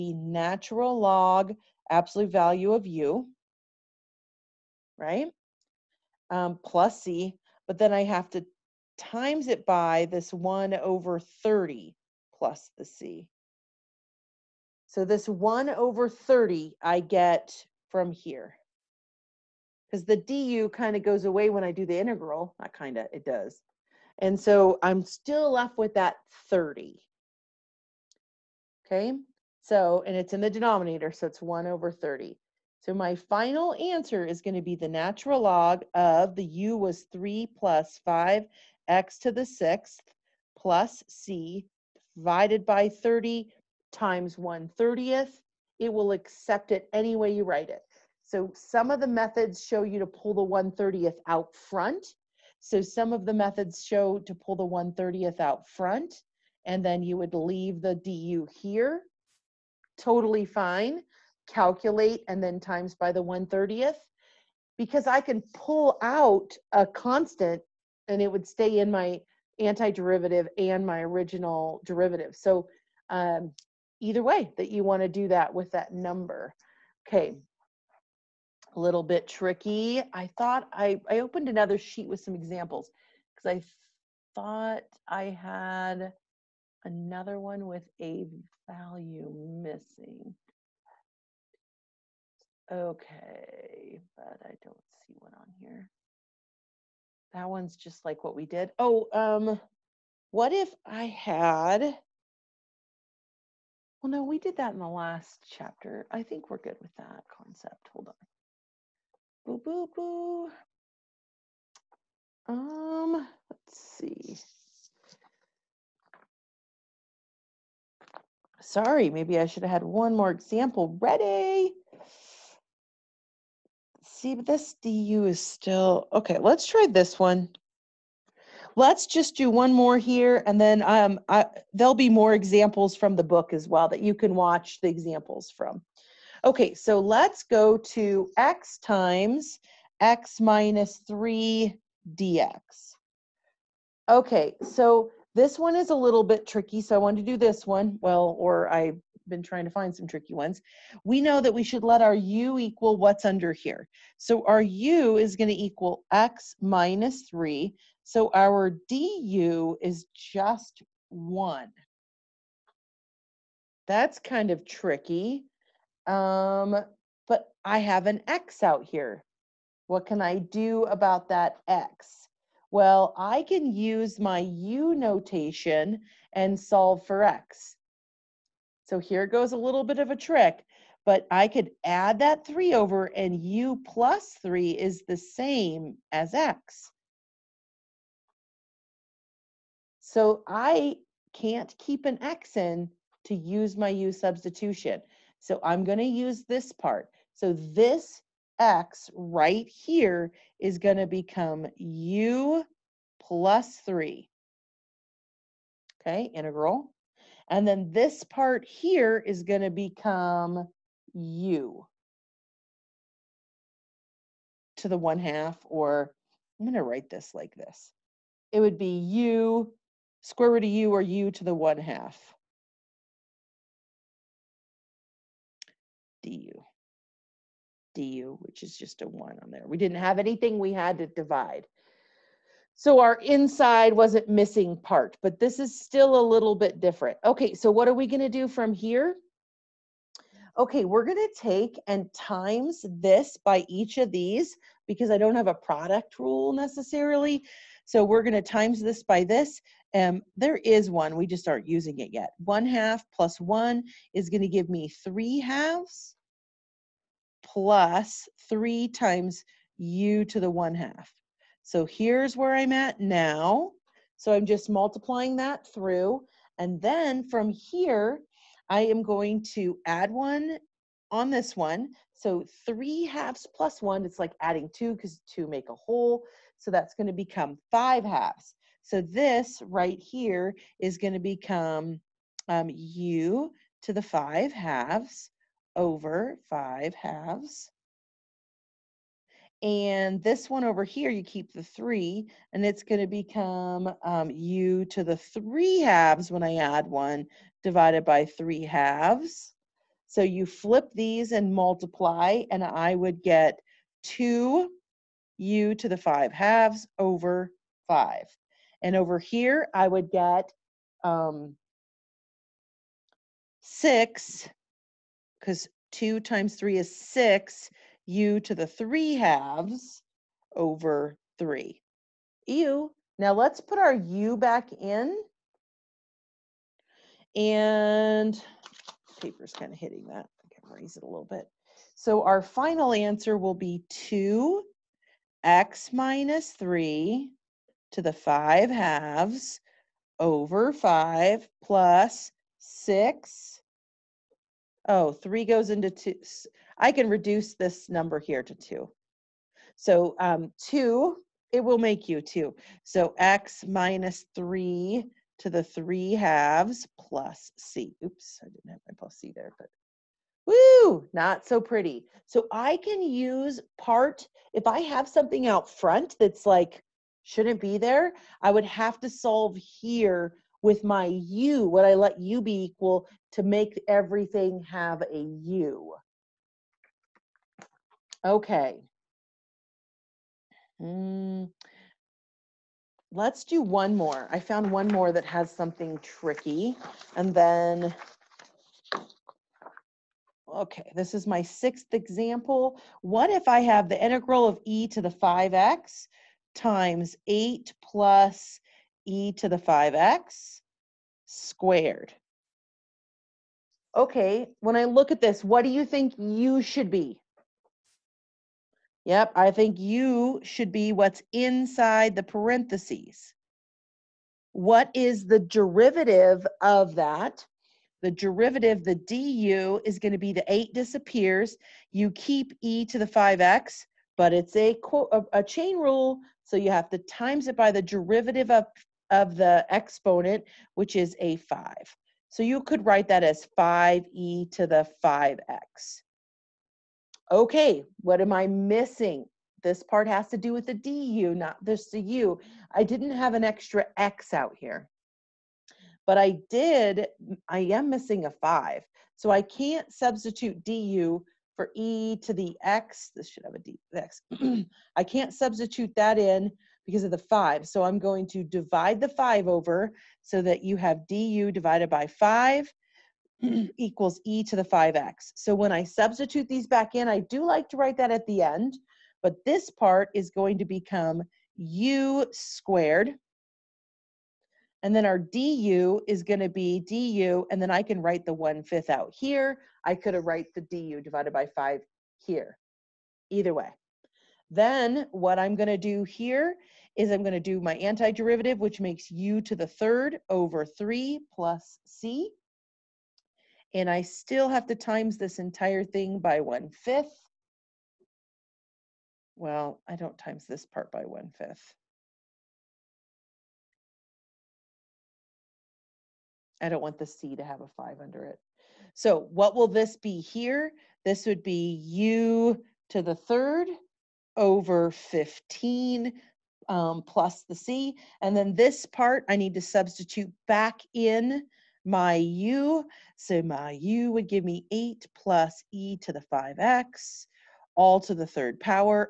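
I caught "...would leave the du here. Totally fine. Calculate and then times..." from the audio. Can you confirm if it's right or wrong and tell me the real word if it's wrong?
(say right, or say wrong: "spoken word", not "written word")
right.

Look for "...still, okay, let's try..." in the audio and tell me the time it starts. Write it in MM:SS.
02:05.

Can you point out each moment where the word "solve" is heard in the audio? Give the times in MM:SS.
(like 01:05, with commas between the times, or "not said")
02:56, 06:09.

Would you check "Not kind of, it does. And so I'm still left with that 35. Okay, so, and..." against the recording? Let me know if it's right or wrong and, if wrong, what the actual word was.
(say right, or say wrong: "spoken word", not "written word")
wrong: "30", not "35".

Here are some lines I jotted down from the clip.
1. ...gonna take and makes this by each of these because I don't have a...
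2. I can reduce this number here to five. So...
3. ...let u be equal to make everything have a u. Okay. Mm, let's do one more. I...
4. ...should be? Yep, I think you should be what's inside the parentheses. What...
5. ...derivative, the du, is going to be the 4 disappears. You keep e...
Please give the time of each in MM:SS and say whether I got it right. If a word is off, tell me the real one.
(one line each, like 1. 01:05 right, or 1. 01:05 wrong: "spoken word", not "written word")
1. 04:01 wrong: "times", not "makes"
2. 05:46 wrong: "two", not "five"
3. 06:11 right
4. 06:46 right
5. 06:58 wrong: "8", not "4".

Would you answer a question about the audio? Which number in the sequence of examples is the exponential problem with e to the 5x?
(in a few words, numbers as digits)
sixth.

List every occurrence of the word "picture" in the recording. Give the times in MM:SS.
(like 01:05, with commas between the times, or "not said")
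not said.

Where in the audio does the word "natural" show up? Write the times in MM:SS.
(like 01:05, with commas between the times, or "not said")
00:00, 00:34.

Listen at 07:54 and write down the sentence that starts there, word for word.
And then our du is going to be du, and then I can write the 1 fifth out here.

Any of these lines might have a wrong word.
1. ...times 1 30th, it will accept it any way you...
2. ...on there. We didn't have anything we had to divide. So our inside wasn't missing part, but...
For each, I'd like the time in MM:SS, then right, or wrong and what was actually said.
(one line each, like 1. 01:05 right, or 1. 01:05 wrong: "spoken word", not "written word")
1. 00:43 right
2. 03:49 right.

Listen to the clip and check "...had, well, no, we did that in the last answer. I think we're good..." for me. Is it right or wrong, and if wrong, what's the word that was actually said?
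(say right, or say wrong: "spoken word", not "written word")
wrong: "chapter", not "answer".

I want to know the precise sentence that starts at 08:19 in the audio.
Well, I don't times this part by one fifth.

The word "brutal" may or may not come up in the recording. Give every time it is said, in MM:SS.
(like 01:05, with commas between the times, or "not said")
not said.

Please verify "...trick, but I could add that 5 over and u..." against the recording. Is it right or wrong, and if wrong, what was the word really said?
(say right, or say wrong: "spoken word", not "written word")
wrong: "3", not "5".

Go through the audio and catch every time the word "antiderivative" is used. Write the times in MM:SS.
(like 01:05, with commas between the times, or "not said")
01:09, 08:07.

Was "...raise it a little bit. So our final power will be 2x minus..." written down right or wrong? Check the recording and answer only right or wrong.
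wrong.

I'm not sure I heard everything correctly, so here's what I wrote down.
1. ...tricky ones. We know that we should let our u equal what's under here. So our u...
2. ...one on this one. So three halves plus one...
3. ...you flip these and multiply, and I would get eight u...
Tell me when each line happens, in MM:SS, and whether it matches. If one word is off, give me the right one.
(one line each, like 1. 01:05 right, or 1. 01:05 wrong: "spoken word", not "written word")
1. 02:30 right
2. 04:30 right
3. 05:00 wrong: "two", not "eight".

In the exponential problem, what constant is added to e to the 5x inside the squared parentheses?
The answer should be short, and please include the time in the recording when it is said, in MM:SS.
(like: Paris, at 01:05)
8, at 06:37.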